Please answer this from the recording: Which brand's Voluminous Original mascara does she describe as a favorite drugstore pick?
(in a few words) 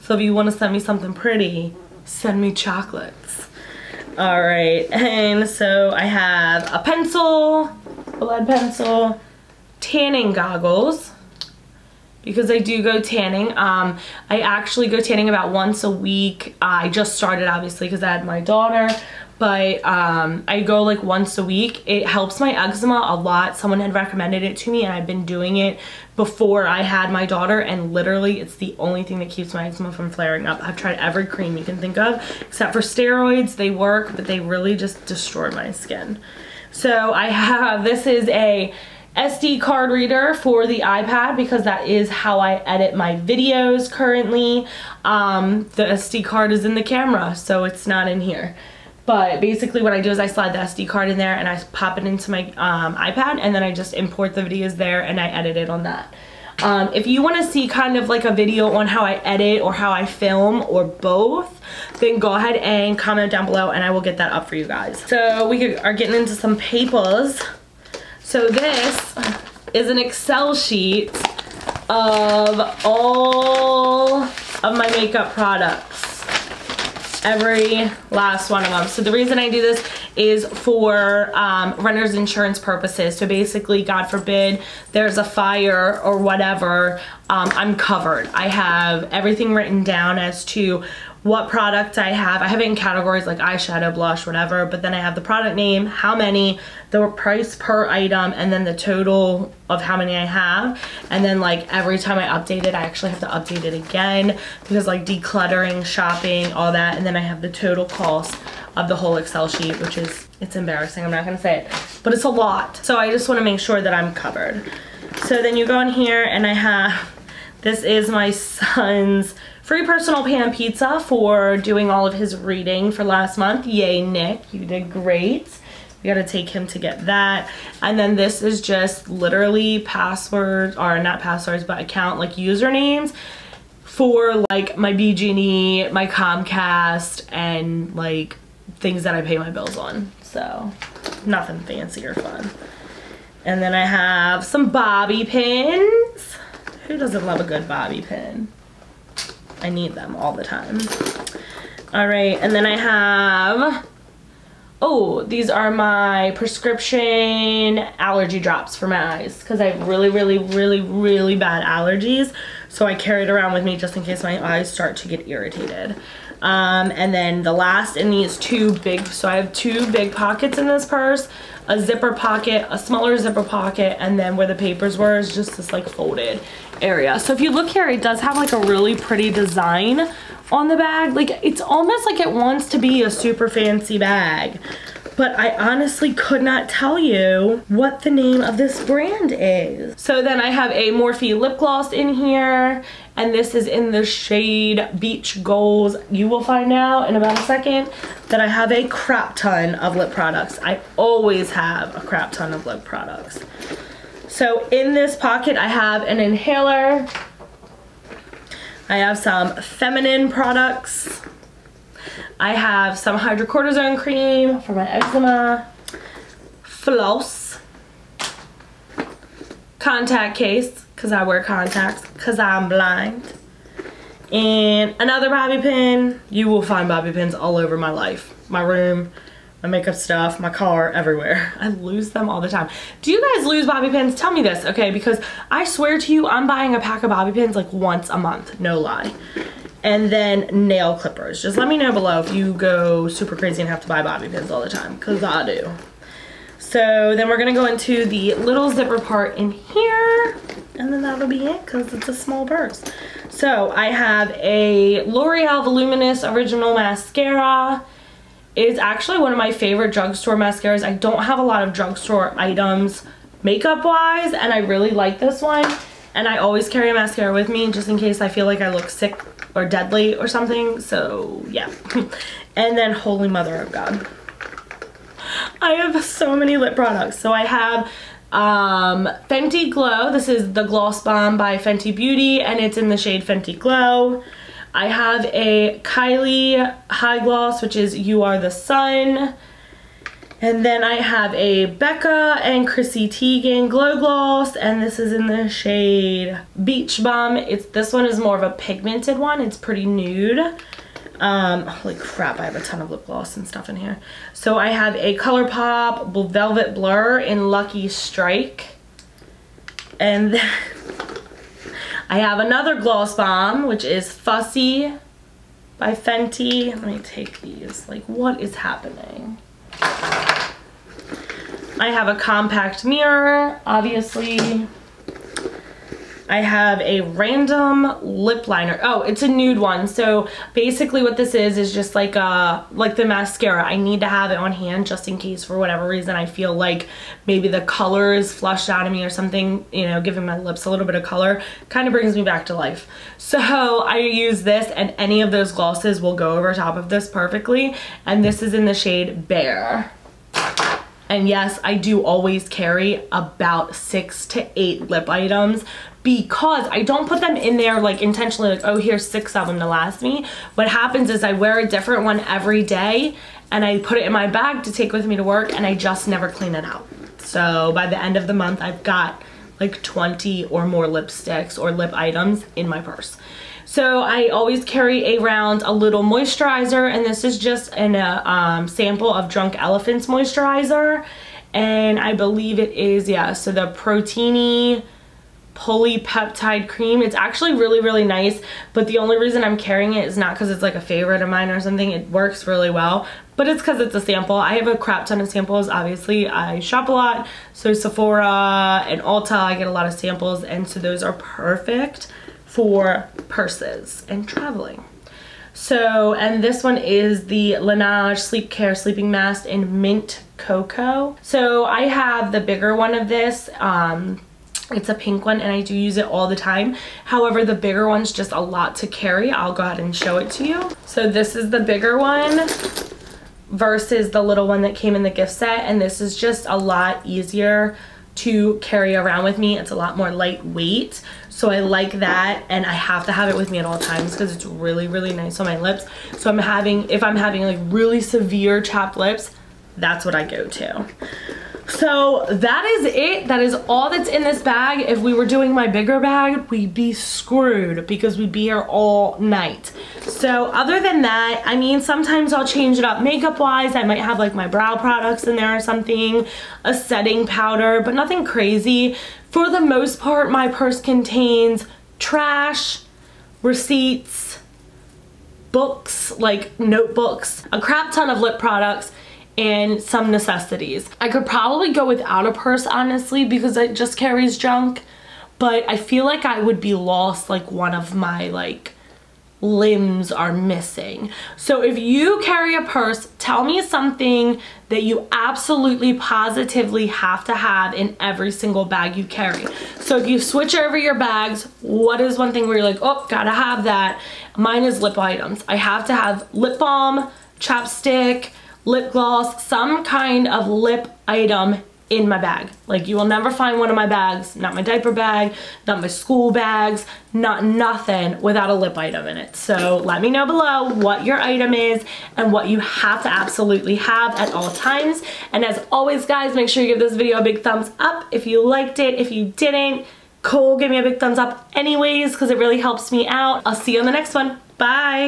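L'Oreal.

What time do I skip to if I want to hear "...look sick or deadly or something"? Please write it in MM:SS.
04:28.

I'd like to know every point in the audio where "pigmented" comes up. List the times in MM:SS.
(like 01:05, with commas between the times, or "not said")
04:58.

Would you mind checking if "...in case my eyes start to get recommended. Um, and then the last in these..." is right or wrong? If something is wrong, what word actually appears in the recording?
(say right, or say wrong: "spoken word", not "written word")
wrong: "irritated", not "recommended".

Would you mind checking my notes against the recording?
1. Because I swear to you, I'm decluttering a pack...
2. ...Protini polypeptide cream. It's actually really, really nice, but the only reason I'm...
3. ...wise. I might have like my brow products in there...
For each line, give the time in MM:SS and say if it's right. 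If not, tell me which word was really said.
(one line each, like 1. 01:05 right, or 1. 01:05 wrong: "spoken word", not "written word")
1. 03:54 wrong: "buying", not "decluttering"
2. 06:23 right
3. 07:33 right.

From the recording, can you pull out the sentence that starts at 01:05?
So we are getting into some papers.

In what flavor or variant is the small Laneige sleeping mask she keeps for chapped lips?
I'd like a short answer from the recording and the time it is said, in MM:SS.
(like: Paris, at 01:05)
Mint Cocoa, at 06:49.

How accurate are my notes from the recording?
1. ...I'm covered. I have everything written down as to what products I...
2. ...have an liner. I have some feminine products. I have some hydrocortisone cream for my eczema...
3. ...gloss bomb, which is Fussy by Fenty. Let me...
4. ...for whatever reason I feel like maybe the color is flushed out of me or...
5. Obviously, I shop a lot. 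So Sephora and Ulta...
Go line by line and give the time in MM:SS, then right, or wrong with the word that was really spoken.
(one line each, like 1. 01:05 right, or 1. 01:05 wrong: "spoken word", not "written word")
1. 01:27 right
2. 03:25 wrong: "inhaler", not "liner"
3. 05:12 right
4. 05:35 right
5. 06:35 right.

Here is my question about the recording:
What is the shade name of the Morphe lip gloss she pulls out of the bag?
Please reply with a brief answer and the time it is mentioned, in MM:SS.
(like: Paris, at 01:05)
Beach Goals, at 03:14.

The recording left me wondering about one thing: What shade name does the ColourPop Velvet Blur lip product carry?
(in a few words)
Lucky Strike.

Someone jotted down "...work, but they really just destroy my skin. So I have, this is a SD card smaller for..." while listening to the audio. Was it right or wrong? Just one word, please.
wrong.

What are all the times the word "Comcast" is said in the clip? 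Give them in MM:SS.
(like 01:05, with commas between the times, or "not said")
02:16.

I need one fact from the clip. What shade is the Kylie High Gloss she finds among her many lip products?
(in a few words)
You Are the Sun.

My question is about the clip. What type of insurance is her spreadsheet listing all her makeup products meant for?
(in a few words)
Renter's insurance.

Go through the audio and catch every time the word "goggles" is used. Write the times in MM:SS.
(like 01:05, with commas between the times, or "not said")
00:10.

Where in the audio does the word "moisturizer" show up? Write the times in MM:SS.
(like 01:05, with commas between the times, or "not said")
06:16, 06:20.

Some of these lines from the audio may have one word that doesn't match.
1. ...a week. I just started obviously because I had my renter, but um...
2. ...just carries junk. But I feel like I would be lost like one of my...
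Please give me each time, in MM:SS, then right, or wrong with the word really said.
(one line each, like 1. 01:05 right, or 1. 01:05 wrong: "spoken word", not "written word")
1. 00:15 wrong: "daughter", not "renter"
2. 07:53 right.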